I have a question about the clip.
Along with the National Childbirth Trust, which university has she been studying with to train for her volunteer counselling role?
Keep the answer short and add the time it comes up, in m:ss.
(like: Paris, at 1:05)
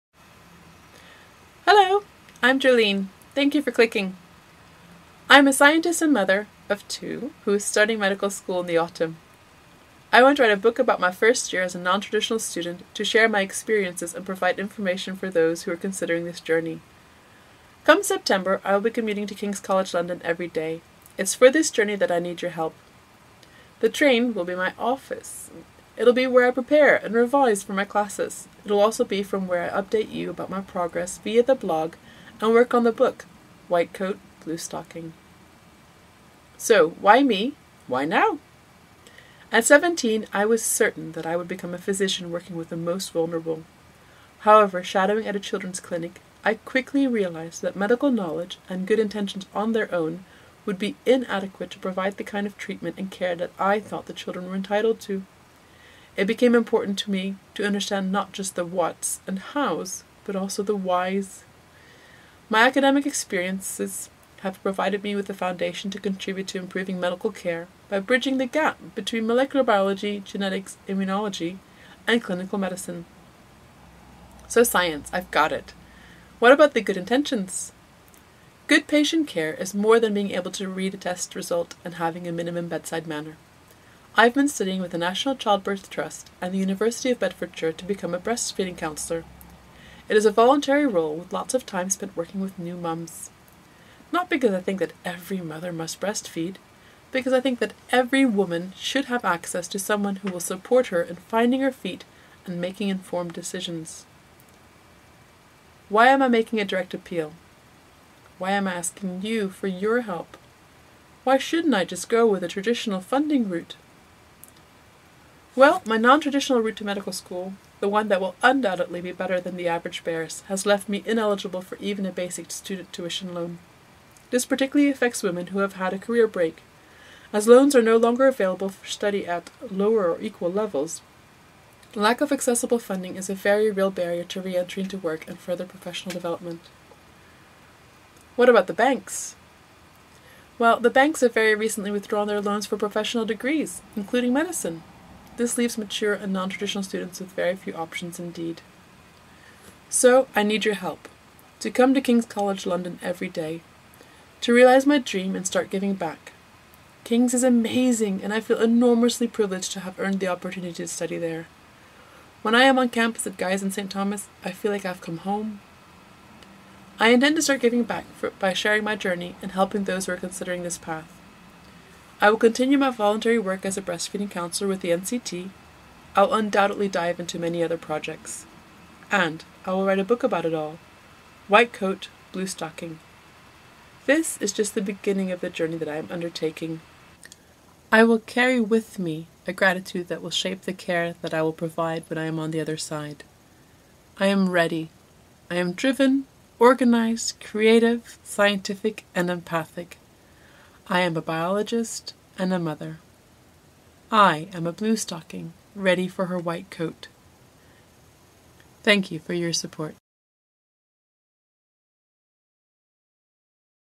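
University of Bedfordshire, at 1:26.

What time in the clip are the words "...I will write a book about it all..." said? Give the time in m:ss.
2:59.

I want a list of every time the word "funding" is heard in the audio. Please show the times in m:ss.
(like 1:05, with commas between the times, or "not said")
1:52, 2:12.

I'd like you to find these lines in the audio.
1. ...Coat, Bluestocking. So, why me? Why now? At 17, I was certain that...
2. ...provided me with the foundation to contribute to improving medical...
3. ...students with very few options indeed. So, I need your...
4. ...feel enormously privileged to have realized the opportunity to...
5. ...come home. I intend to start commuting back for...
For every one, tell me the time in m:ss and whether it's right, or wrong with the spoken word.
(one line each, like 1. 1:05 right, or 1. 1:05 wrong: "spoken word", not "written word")
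1. 0:33 right
2. 1:04 right
3. 2:26 right
4. 2:38 wrong: "earned", not "realized"
5. 2:45 wrong: "giving", not "commuting".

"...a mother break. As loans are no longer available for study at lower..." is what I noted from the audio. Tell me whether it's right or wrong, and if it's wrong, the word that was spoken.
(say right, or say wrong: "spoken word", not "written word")
wrong: "career", not "mother".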